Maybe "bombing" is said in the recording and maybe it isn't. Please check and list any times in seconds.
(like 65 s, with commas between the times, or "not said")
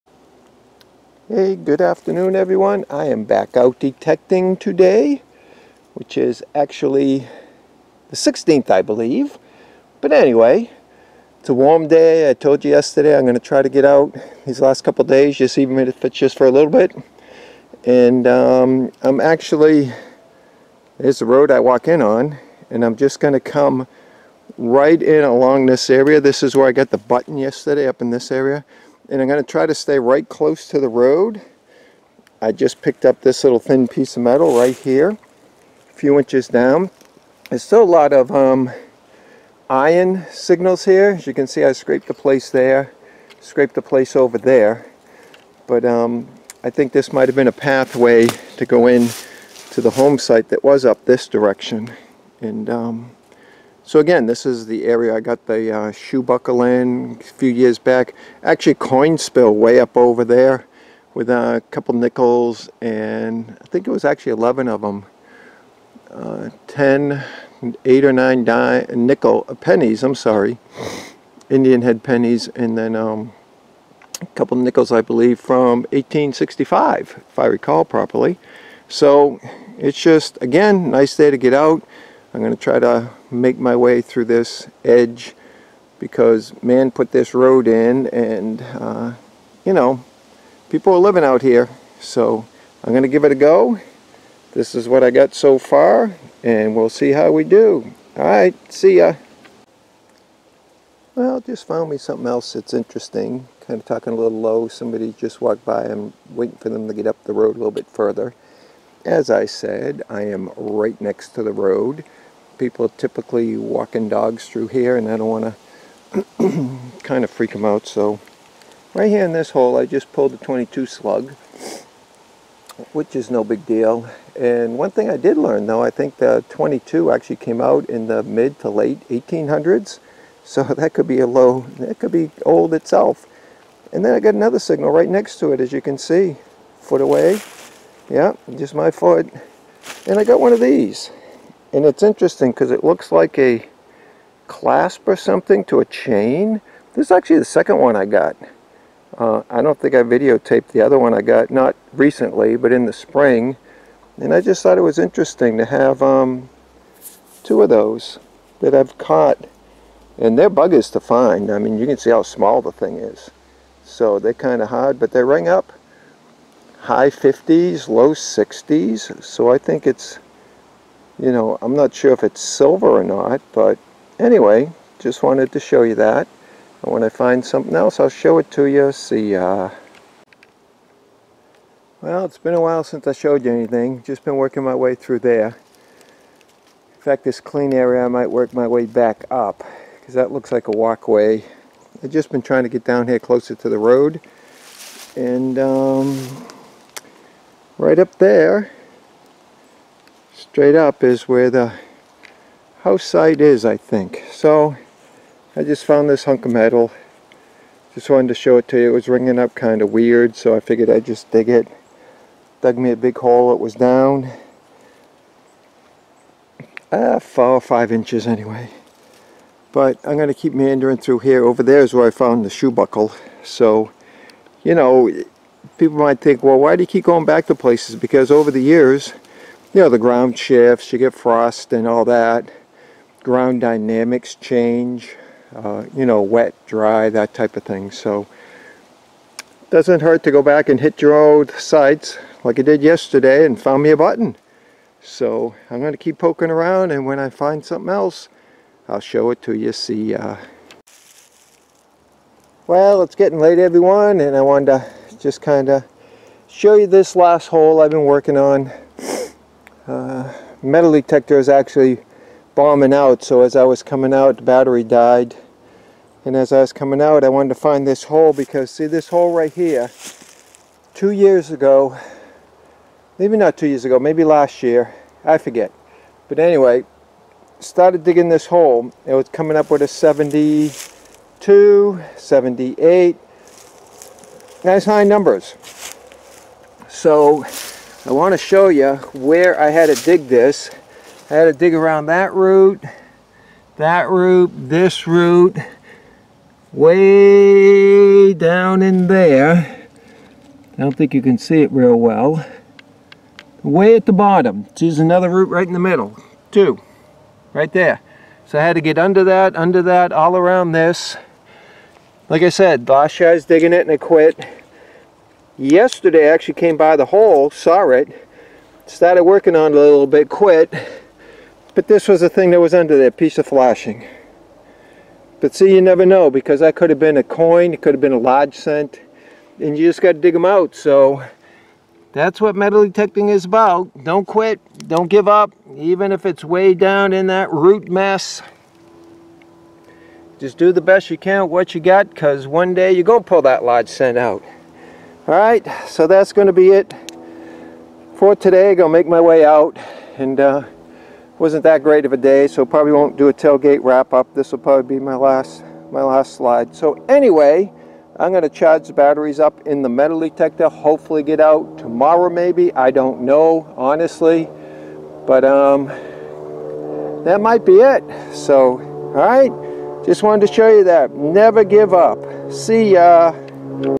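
262 s.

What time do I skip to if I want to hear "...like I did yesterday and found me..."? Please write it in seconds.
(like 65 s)
242 s.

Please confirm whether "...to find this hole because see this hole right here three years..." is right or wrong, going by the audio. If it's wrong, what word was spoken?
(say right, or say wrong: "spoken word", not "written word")
wrong: "two", not "three".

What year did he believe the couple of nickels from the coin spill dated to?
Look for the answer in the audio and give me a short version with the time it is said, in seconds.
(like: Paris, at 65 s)
1865, at 75 s.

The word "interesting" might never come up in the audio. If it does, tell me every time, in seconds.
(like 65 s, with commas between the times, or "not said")
102 s, 142 s, 154 s.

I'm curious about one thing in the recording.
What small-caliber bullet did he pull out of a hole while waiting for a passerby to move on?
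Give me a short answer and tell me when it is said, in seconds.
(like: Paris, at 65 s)
22 slug, at 120 s.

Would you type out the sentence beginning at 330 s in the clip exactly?
So that's what metal detecting is about.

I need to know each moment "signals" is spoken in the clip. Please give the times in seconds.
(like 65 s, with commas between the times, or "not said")
40 s, 134 s.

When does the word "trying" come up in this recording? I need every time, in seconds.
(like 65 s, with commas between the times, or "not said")
192 s.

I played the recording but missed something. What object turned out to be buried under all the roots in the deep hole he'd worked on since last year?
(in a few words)
piece of flashing.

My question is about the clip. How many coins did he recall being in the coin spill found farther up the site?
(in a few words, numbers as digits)
11.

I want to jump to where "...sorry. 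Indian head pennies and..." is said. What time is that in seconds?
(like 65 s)
70 s.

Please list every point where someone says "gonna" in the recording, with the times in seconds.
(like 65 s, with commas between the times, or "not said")
92 s, 348 s, 358 s.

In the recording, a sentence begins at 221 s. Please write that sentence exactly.
Over there is where I found the shoe buckle.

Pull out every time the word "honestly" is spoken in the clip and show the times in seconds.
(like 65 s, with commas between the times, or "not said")
363 s.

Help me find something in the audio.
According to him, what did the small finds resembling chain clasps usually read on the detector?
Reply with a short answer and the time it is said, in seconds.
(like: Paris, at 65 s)
high 50s, low 60s, at 166 s.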